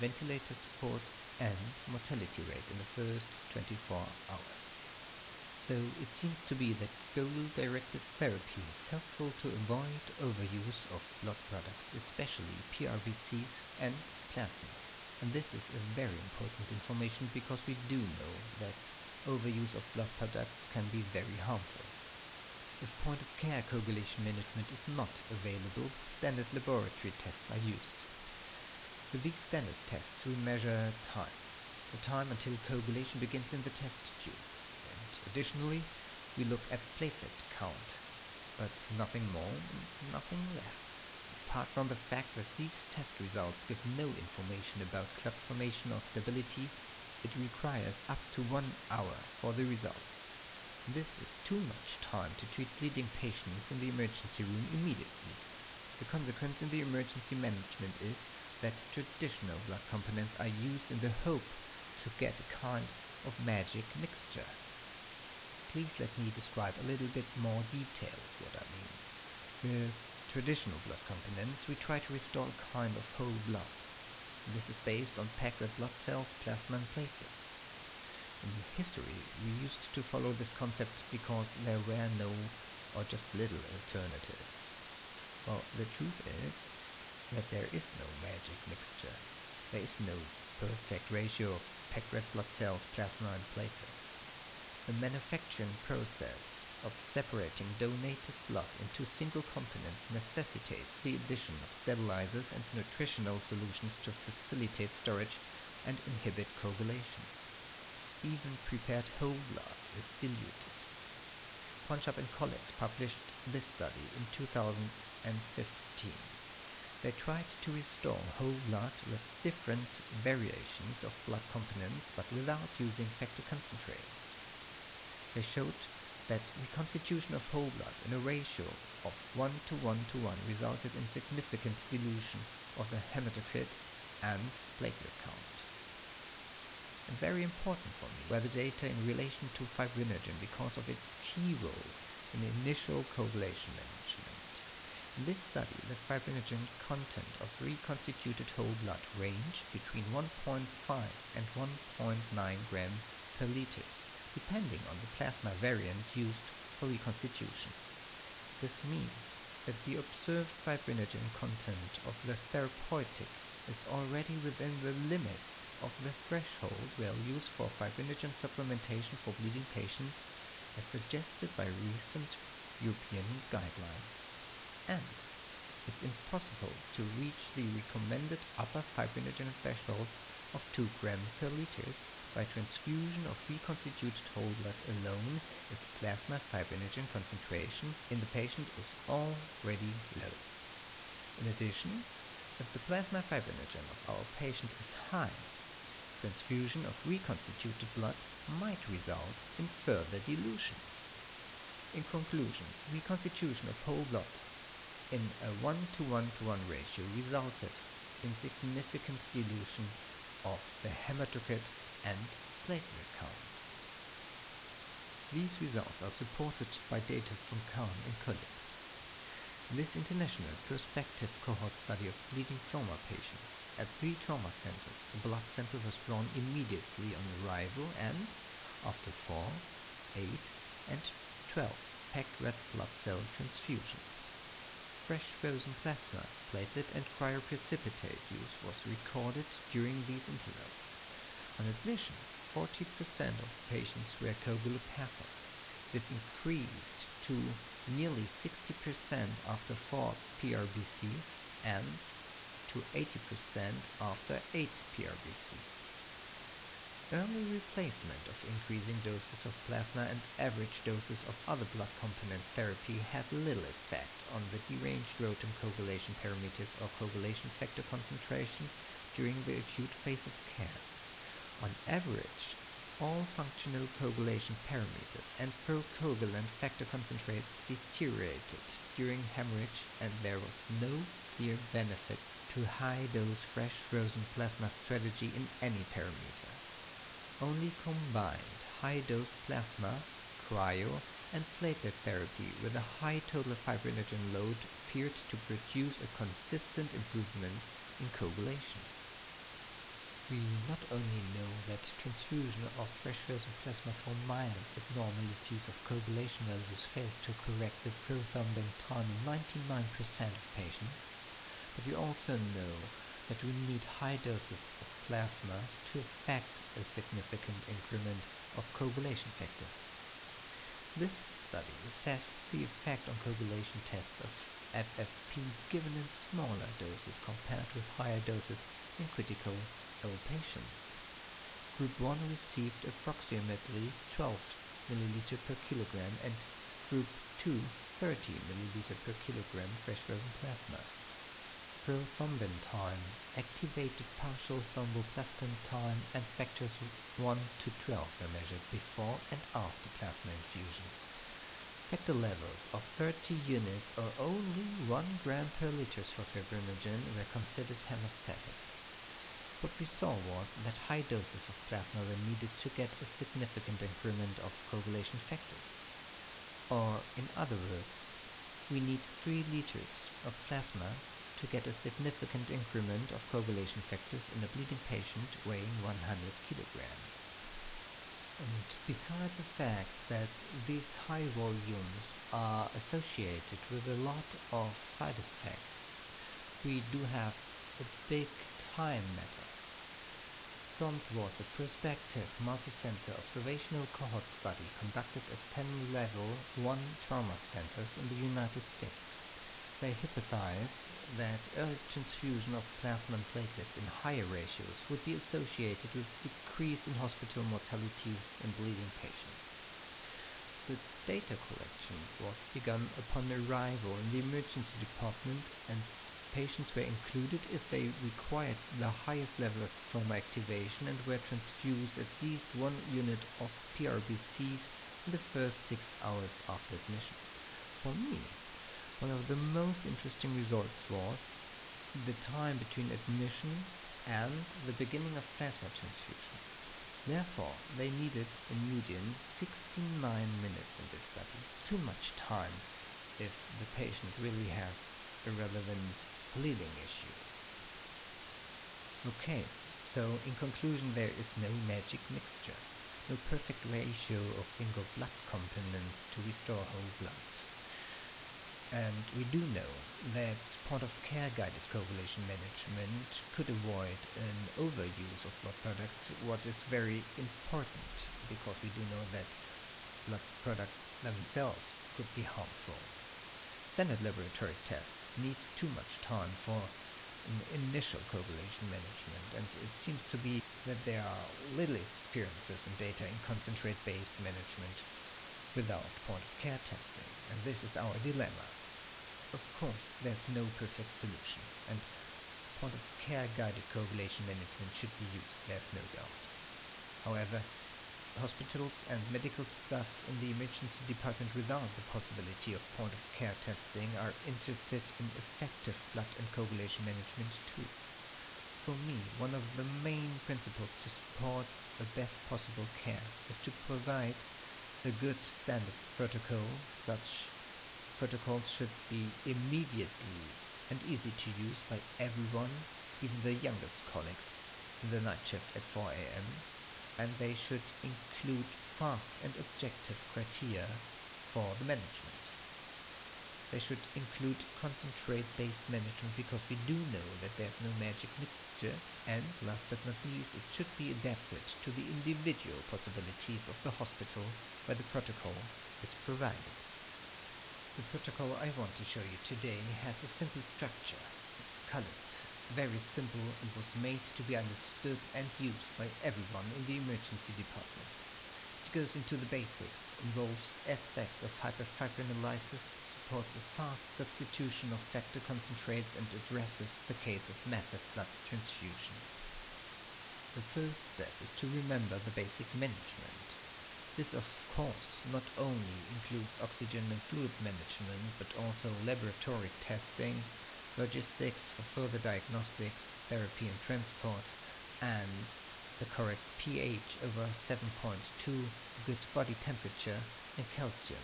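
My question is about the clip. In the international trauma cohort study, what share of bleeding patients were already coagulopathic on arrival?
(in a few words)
40%.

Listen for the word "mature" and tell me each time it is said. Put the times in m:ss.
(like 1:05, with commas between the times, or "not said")
not said.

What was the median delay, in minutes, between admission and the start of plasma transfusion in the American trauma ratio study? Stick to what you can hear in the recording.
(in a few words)
69.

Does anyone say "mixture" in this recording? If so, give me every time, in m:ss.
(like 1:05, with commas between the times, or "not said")
1:03, 1:28, 7:32, 8:58.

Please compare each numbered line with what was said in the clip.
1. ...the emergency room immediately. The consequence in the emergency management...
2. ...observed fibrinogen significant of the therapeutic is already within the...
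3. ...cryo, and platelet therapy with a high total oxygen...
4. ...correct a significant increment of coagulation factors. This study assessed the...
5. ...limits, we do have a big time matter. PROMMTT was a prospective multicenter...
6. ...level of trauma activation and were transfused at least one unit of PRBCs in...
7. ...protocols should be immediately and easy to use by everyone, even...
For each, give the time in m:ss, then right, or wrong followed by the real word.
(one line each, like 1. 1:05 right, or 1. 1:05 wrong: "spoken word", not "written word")
1. 0:53 right
2. 2:39 wrong: "content", not "significant"
3. 4:50 wrong: "fibrinogen", not "oxygen"
4. 5:15 wrong: "effect", not "correct"
5. 6:25 wrong: "effects", not "limits"
6. 6:59 right
7. 8:37 right.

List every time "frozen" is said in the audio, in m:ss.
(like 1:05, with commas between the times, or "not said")
3:55, 4:43, 5:03, 5:40.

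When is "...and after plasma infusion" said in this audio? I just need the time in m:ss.
5:49.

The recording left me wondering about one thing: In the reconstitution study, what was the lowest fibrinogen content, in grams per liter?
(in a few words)
1.5.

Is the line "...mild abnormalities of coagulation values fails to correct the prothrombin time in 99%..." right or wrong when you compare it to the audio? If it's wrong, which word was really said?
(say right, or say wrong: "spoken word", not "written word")
right.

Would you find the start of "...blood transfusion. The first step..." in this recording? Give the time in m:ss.
9:27.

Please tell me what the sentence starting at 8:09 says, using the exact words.
Of course, there's no perfect solution, and point of care guided coagulation management should be used, there's no doubt.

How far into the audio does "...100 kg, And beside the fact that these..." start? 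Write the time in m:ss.
6:15.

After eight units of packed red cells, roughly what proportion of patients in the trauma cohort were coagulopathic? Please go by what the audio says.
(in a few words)
80%.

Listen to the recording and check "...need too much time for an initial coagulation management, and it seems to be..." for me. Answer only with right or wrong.
right.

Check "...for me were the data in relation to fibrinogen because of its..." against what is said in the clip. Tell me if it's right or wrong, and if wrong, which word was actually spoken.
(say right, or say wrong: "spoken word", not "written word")
right.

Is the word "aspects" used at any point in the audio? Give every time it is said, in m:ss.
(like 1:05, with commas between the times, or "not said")
9:20.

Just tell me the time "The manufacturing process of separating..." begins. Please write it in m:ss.
1:34.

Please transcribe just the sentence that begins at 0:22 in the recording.
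If point-of-care coagulation management is not available, standard laboratory tests are used.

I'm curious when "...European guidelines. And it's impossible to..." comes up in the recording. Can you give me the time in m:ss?
2:52.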